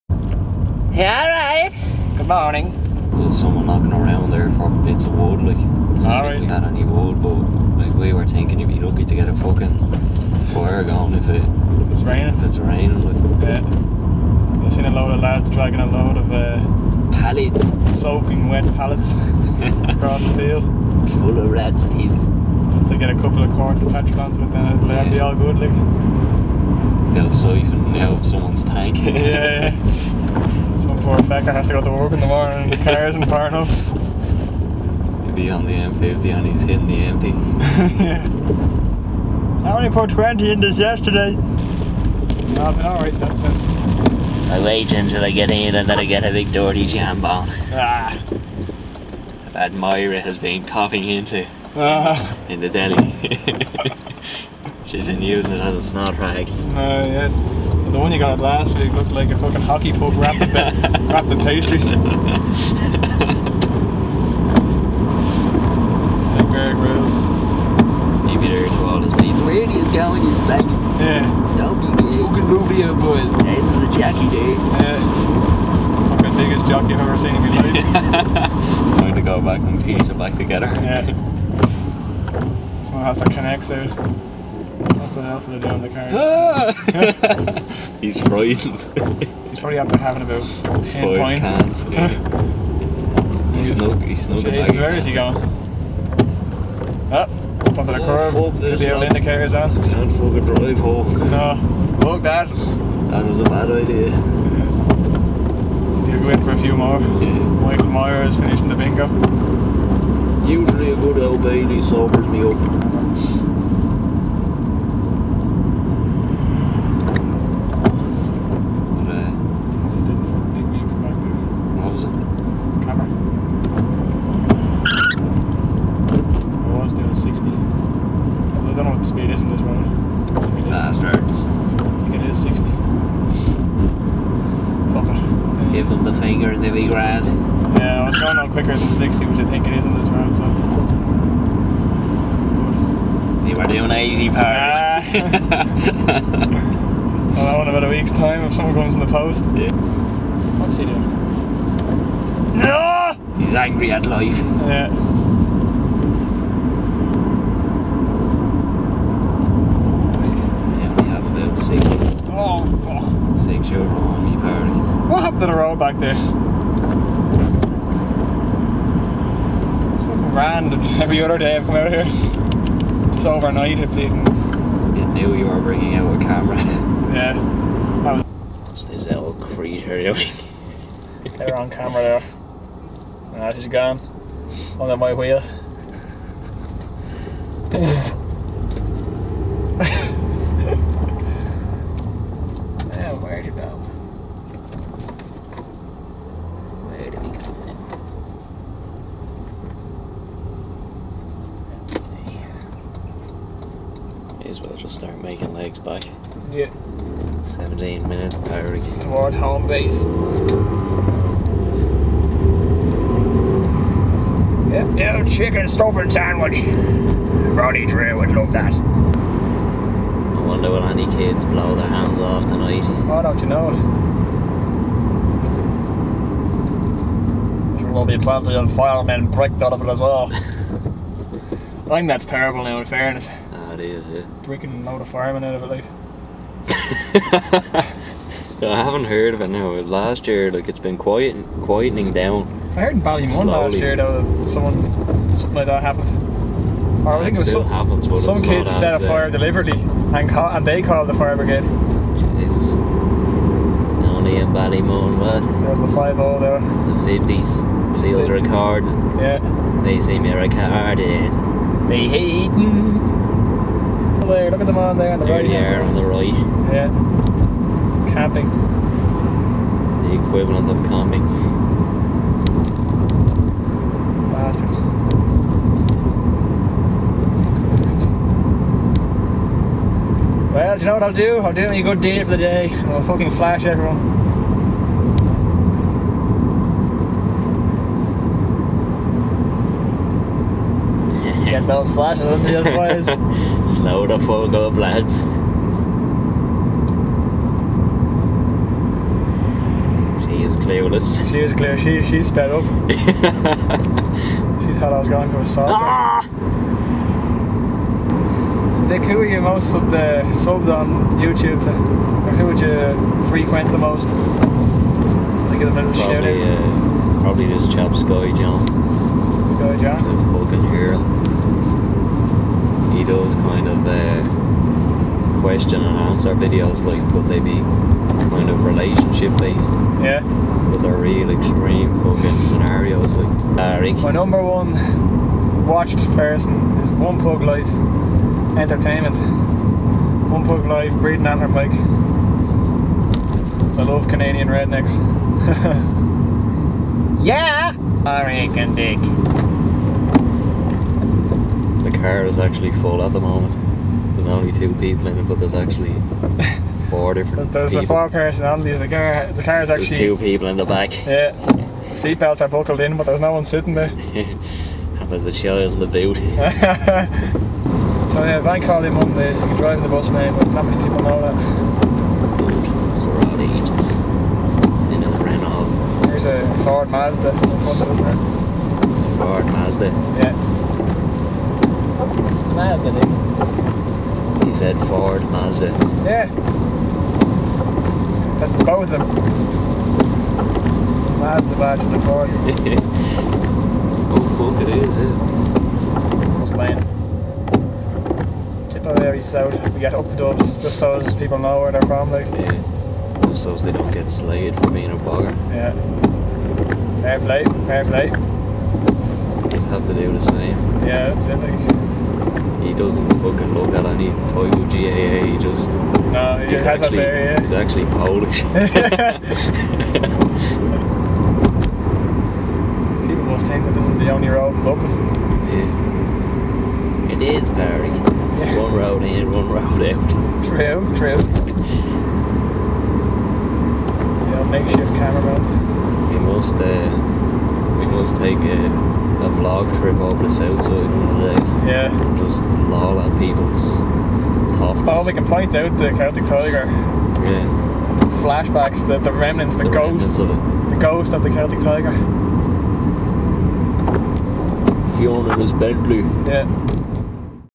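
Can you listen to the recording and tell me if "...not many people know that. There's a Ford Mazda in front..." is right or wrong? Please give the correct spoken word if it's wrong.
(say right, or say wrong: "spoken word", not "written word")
right.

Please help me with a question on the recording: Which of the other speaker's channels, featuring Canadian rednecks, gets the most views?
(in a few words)
One Pug Life Entertainment.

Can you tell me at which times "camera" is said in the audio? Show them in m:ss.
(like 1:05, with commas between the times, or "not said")
2:56, 3:01, 7:14.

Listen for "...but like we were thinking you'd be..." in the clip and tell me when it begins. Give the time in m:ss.
0:07.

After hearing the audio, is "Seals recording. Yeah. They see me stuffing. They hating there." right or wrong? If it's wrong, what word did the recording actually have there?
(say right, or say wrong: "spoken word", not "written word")
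wrong: "recording", not "stuffing".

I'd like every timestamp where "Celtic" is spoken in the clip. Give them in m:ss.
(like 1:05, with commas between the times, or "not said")
7:25, 7:31.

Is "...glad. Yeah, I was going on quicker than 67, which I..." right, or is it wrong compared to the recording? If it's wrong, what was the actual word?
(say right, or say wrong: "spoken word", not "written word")
wrong: "60", not "67".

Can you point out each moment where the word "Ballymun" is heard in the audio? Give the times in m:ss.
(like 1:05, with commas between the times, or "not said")
4:03, 4:14.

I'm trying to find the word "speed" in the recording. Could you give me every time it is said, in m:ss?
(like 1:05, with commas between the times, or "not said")
2:09.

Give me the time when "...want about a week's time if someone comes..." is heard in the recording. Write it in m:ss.
2:27.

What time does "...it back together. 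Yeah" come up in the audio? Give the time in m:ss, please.
1:20.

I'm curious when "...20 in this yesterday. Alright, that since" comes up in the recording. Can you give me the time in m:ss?
0:40.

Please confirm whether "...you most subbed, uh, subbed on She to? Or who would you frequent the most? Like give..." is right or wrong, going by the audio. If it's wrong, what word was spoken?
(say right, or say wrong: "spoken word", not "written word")
wrong: "YouTube", not "She".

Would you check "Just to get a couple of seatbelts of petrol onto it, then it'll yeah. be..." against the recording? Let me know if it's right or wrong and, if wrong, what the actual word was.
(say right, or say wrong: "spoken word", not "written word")
wrong: "quarts", not "seatbelts".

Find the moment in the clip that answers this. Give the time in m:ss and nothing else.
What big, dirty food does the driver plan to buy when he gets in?
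0:46.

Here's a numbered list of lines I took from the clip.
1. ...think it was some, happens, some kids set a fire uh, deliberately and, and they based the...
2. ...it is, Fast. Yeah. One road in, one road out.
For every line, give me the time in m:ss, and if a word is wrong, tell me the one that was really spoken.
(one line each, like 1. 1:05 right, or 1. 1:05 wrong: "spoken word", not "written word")
1. 4:07 wrong: "called", not "based"
2. 7:07 wrong: "Perry", not "Fast".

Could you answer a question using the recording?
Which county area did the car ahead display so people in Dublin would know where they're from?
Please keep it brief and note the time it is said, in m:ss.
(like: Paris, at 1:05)
Tipperary South, at 6:38.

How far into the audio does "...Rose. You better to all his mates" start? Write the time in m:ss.
1:06.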